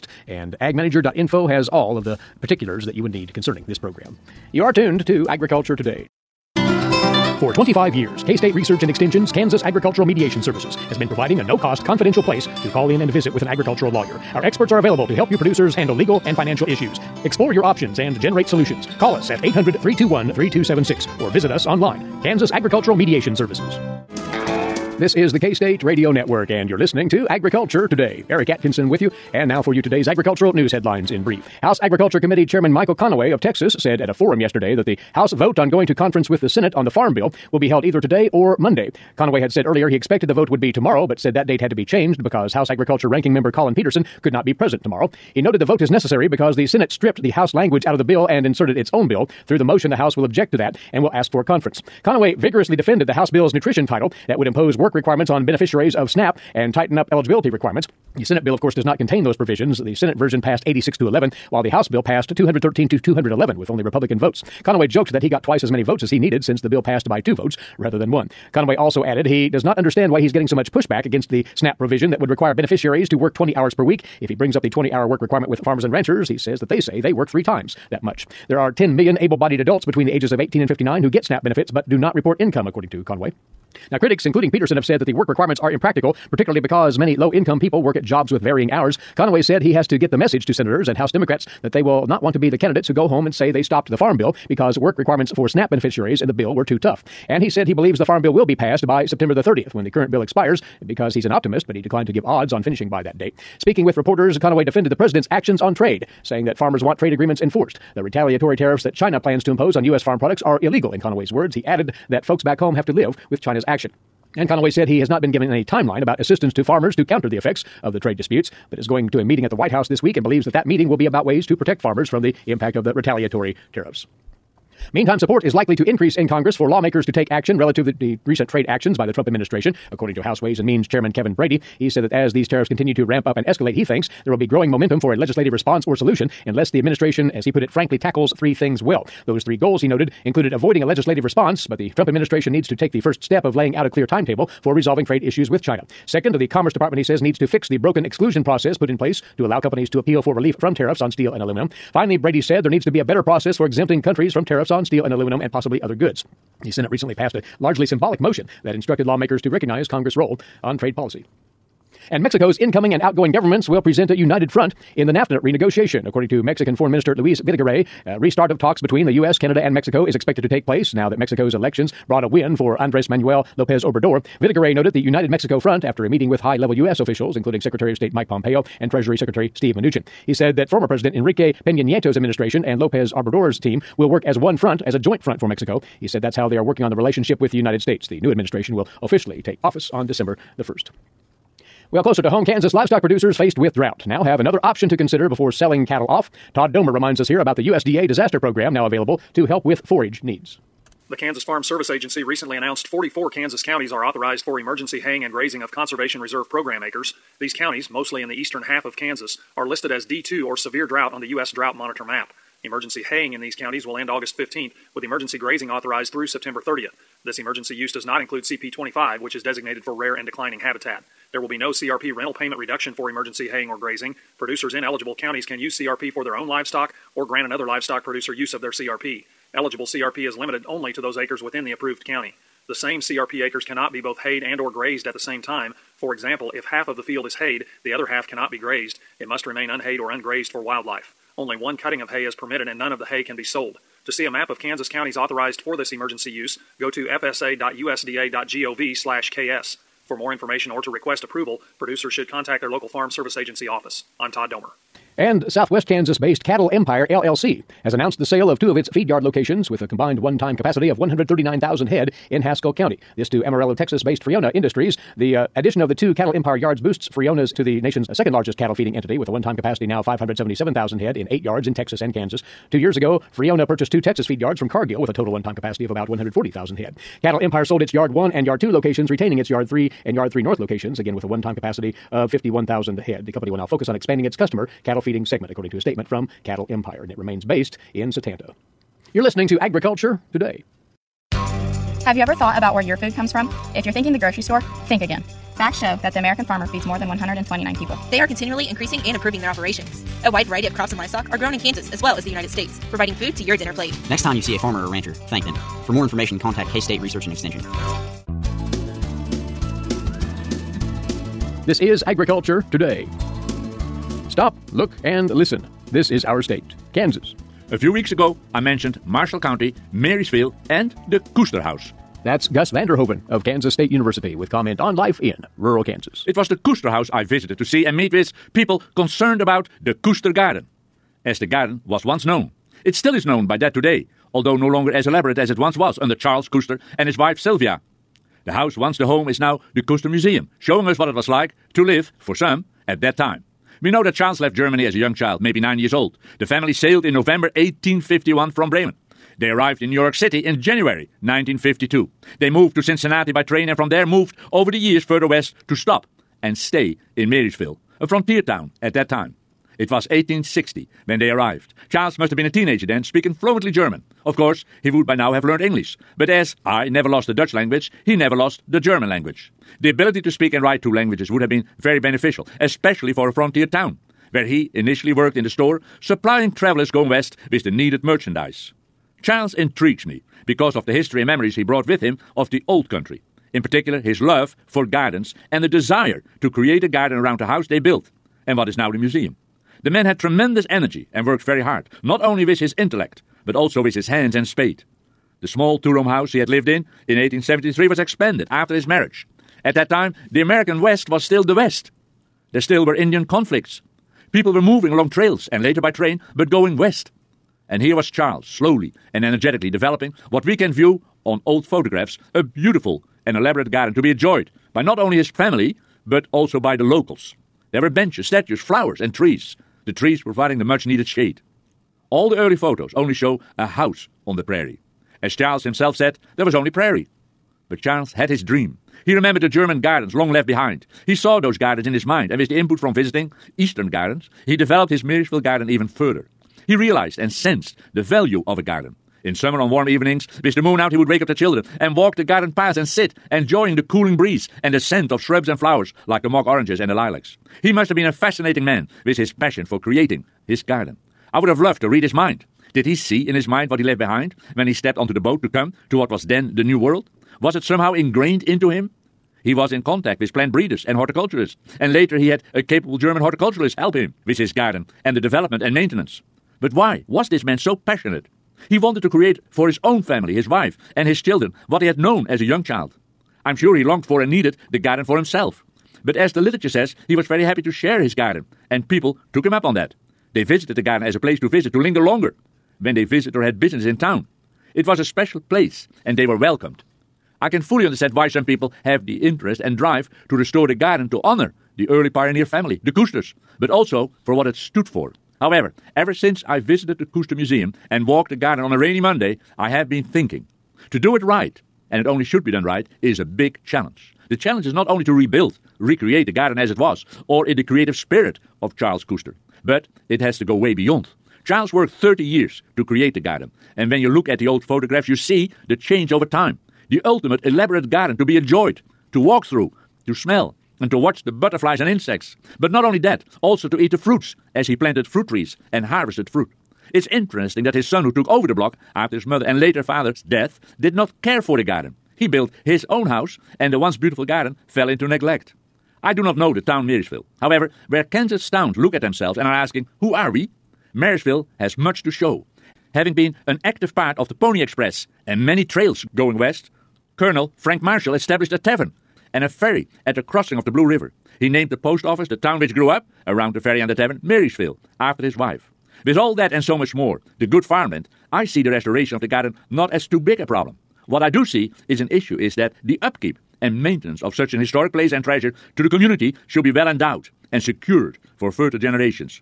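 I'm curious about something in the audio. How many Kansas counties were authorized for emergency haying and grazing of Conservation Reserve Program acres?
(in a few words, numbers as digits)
44.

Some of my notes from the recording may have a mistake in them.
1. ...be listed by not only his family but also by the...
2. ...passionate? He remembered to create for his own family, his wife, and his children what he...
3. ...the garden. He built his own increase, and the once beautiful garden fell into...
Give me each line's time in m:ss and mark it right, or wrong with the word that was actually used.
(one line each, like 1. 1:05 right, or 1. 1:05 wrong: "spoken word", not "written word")
1. 6:54 wrong: "enjoyed", not "listed"
2. 7:47 wrong: "wanted", not "remembered"
3. 8:51 wrong: "house", not "increase".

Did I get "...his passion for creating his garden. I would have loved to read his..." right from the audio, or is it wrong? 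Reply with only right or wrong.
right.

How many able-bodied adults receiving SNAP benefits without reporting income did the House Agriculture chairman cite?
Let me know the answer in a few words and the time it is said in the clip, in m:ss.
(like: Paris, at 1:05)
10 million, at 1:18.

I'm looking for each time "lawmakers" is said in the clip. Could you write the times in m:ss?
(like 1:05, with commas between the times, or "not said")
2:06, 2:39.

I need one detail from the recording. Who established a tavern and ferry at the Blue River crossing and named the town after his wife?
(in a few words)
Frank Marshall.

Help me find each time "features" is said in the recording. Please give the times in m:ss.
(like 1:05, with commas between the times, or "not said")
not said.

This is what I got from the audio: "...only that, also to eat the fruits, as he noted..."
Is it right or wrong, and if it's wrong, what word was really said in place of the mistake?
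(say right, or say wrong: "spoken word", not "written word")
wrong: "planted", not "noted".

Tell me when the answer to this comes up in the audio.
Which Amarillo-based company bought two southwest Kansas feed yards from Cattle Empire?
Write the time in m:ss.
4:24.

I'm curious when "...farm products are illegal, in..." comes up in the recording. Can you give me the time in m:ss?
1:50.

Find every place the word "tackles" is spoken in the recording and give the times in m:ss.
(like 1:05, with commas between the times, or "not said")
2:17.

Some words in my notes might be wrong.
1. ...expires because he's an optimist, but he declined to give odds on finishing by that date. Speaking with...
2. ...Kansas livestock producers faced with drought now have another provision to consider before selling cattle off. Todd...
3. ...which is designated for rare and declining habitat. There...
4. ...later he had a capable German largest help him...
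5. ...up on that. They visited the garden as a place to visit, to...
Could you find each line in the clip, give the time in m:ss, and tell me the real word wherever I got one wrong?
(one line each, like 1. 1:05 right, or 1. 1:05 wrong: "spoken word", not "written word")
1. 1:40 right
2. 3:12 wrong: "option", not "provision"
3. 3:39 right
4. 7:41 wrong: "horticulturist", not "largest"
5. 7:59 right.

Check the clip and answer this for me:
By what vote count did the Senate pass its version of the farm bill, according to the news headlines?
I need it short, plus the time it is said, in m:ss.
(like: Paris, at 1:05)
86 to 11, at 1:00.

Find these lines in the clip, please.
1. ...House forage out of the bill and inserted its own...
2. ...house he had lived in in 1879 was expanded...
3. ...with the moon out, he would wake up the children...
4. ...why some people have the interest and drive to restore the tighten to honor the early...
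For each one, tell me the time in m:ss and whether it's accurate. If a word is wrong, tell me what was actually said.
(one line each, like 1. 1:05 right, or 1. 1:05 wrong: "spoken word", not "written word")
1. 0:47 wrong: "language", not "forage"
2. 6:36 wrong: "1873", not "1879"
3. 7:20 right
4. 8:08 wrong: "garden", not "tighten".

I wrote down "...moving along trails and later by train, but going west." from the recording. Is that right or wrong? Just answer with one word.
right.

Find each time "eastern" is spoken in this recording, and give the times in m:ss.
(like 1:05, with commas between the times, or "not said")
3:28, 7:13.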